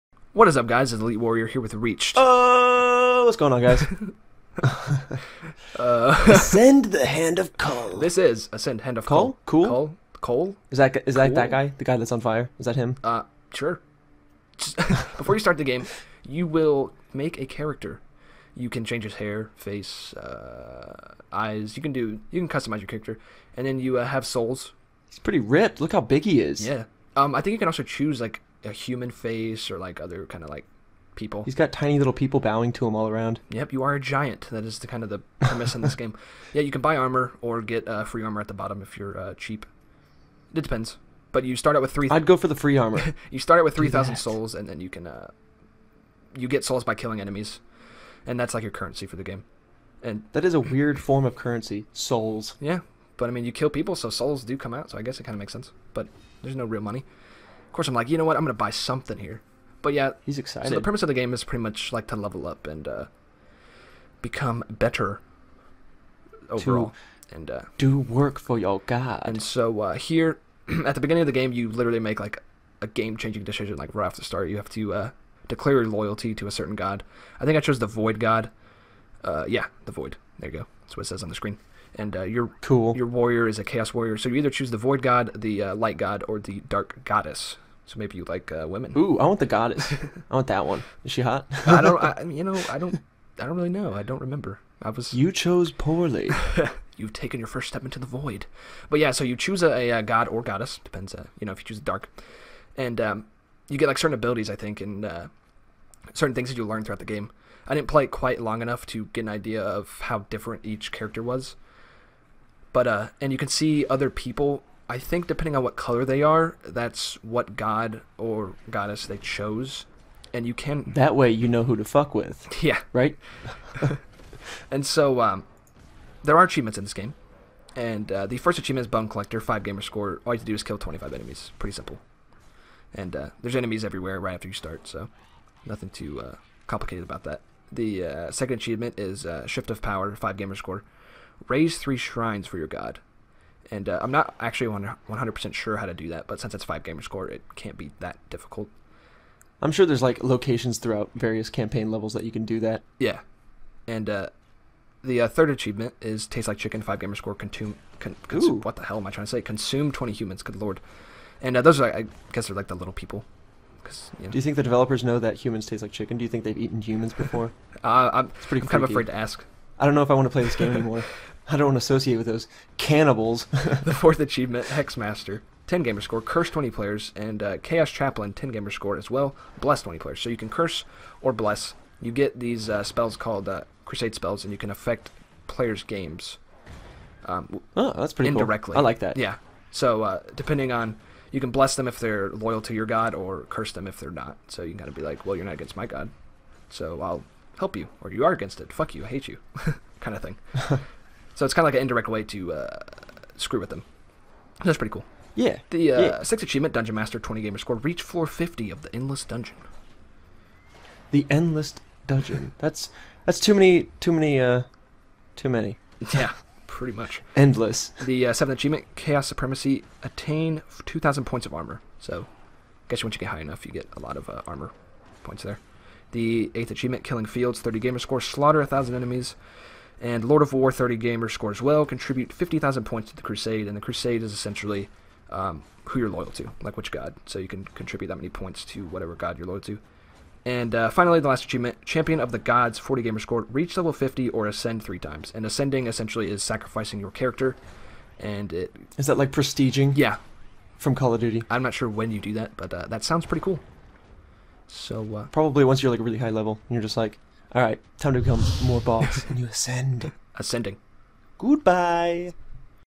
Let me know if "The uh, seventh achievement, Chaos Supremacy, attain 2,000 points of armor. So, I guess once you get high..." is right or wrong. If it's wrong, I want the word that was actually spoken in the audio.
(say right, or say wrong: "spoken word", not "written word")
right.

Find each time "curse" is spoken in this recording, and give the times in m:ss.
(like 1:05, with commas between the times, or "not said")
2:56, 3:00, 3:13.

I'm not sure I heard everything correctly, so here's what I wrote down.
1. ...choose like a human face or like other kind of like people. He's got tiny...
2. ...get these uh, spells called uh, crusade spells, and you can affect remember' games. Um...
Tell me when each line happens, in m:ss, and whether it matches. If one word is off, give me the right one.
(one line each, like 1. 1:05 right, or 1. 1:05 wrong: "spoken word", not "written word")
1. 0:27 right
2. 3:02 wrong: "players", not "remember".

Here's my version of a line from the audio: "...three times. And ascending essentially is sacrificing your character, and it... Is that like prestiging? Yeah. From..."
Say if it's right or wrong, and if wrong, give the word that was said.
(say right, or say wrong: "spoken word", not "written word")
right.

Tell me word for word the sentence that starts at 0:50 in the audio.
And that is a weird form of currency, souls.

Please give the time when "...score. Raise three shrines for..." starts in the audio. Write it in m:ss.
2:20.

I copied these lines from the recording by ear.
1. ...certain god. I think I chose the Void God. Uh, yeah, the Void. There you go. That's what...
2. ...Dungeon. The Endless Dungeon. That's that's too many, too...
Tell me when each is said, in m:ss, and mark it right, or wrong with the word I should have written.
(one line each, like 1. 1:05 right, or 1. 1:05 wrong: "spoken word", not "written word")
1. 1:16 right
2. 3:29 right.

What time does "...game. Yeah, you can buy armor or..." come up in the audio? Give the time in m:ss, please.
0:35.